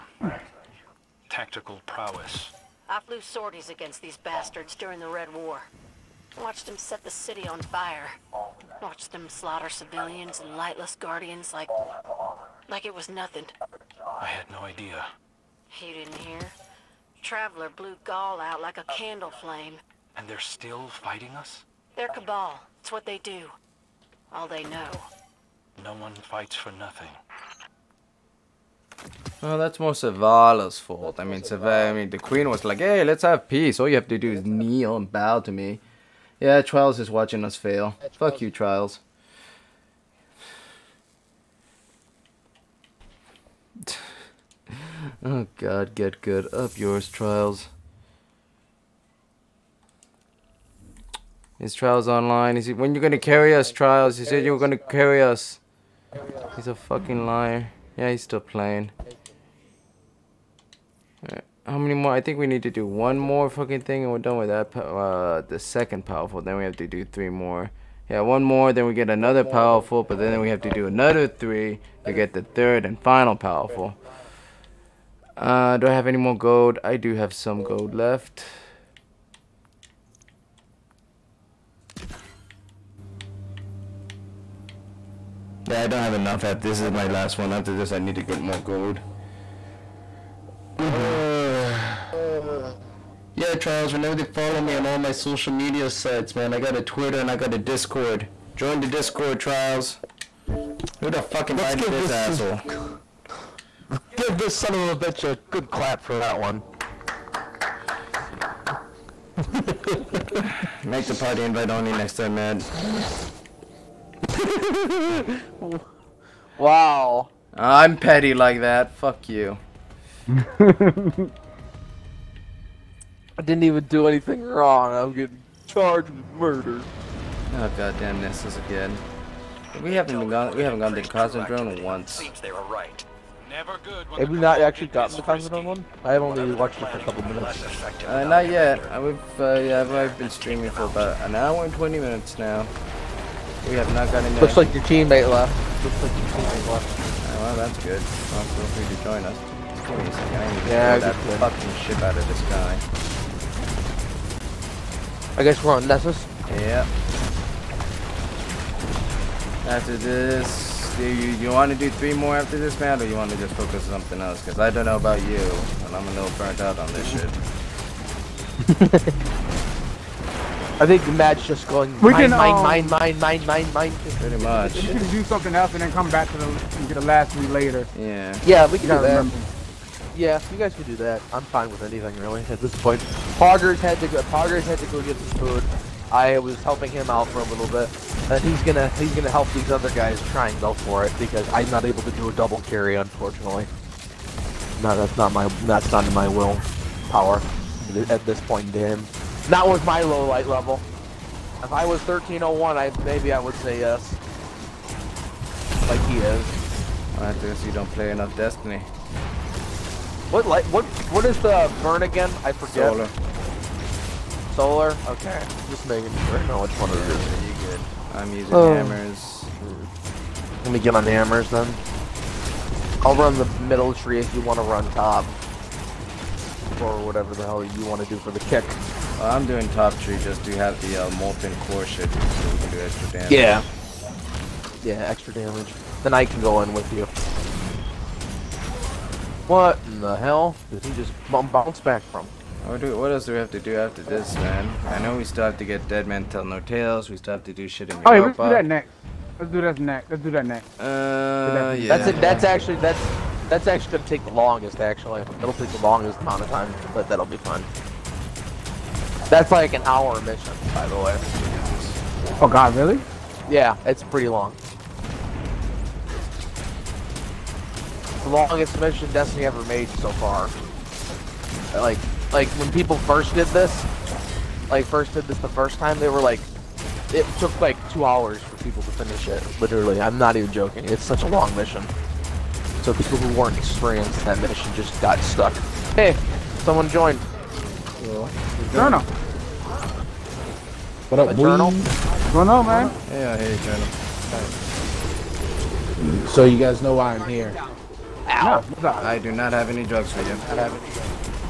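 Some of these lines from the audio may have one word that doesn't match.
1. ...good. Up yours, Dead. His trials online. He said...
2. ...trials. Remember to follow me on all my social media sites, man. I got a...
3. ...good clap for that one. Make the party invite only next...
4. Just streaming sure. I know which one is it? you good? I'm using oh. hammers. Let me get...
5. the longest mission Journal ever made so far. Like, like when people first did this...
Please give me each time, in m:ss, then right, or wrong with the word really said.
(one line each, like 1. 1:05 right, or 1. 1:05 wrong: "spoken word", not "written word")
1. 0:46 wrong: "Trials", not "Dead"
2. 1:33 right
3. 1:45 right
4. 3:35 wrong: "making", not "streaming"
5. 4:28 wrong: "Destiny", not "Journal".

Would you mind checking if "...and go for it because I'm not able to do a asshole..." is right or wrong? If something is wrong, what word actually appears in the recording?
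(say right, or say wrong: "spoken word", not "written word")
wrong: "double", not "asshole".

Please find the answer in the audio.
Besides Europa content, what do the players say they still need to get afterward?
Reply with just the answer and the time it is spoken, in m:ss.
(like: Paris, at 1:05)
Dead Man Tell No Tales, at 4:05.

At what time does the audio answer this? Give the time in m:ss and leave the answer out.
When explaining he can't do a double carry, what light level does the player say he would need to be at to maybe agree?
3:22.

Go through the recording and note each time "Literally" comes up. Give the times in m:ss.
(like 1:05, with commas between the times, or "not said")
4:39.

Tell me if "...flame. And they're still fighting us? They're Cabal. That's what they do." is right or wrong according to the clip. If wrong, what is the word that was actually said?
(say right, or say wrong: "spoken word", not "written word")
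right.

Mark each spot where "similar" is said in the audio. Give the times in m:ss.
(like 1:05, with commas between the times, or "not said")
not said.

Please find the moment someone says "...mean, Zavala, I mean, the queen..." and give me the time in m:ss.
0:31.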